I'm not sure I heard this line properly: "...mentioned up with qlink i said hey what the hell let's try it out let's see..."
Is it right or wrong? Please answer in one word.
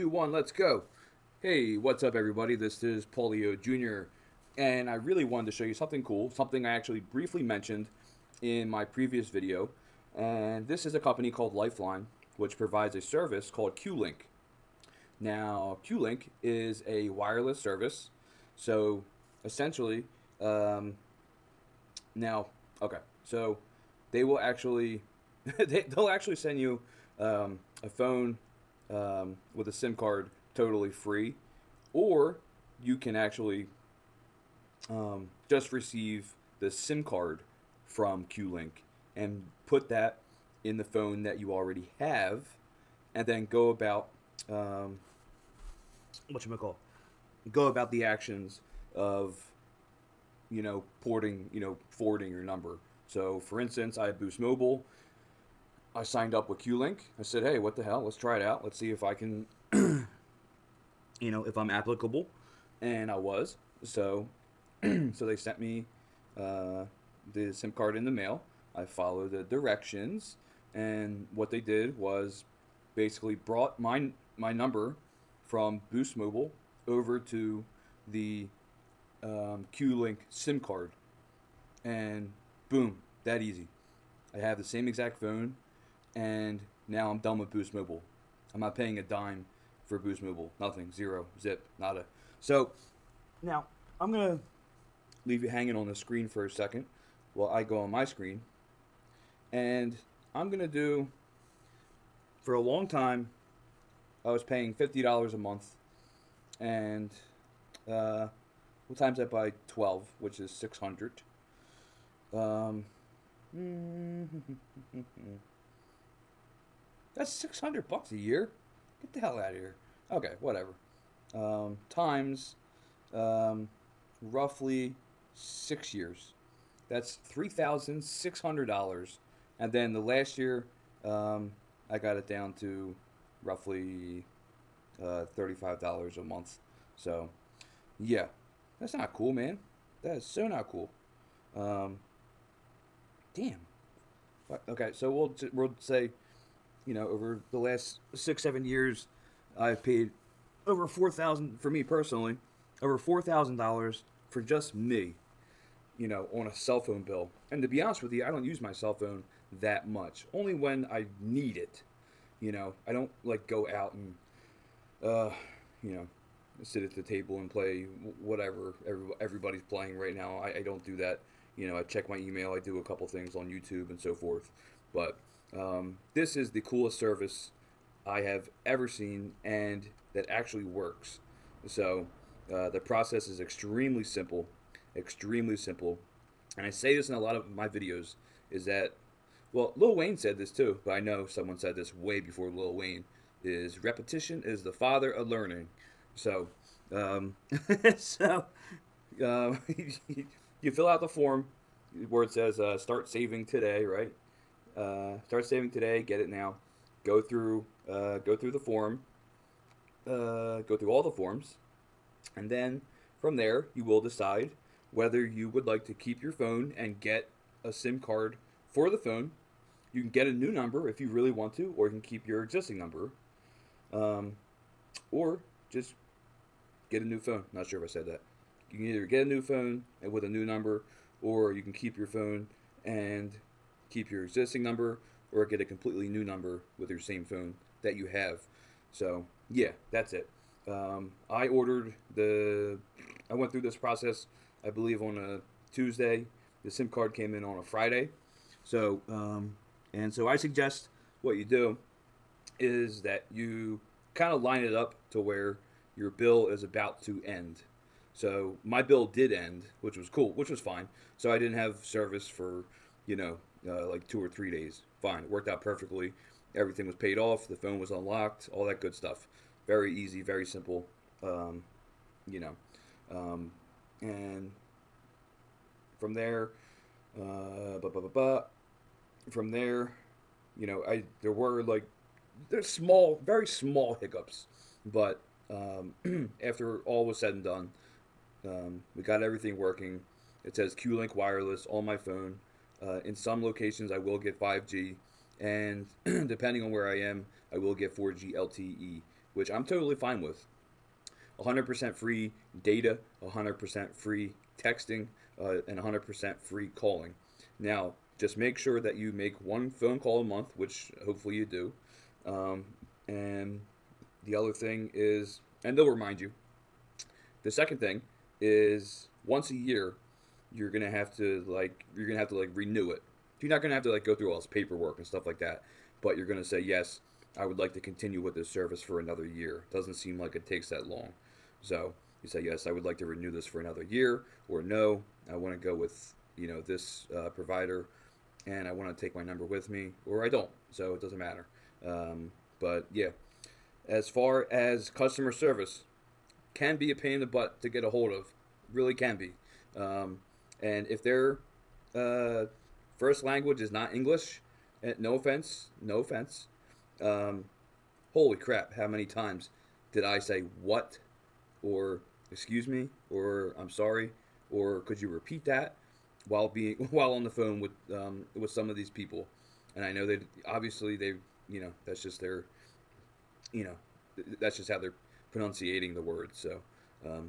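wrong.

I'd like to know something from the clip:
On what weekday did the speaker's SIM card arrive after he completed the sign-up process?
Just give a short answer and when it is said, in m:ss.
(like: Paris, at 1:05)
Friday, at 4:07.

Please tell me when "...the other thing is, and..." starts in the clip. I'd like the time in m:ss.
5:14.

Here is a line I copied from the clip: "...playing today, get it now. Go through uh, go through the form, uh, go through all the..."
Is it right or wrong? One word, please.
wrong.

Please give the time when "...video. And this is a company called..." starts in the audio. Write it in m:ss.
0:09.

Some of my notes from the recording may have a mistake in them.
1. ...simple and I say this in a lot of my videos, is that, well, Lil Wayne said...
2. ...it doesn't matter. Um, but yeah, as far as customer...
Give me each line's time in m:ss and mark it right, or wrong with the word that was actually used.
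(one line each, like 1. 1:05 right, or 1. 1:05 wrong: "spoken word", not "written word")
1. 3:05 right
2. 5:40 right.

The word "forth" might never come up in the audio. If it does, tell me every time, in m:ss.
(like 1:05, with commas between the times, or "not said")
2:54.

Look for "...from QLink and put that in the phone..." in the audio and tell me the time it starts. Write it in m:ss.
0:37.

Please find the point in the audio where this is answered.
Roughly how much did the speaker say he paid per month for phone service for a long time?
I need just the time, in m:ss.
1:44.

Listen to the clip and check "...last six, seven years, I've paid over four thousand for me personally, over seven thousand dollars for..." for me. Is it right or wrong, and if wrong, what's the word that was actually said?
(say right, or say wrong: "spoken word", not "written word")
wrong: "four", not "seven".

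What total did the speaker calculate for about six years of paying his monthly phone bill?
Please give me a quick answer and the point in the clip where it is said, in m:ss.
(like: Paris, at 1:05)
$3,600, at 2:07.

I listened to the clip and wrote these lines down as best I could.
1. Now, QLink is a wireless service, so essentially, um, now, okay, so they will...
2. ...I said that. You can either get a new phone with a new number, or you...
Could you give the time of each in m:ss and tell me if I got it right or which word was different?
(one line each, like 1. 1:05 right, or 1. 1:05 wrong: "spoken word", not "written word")
1. 0:15 right
2. 3:47 right.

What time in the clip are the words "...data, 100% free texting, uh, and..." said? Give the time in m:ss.
5:02.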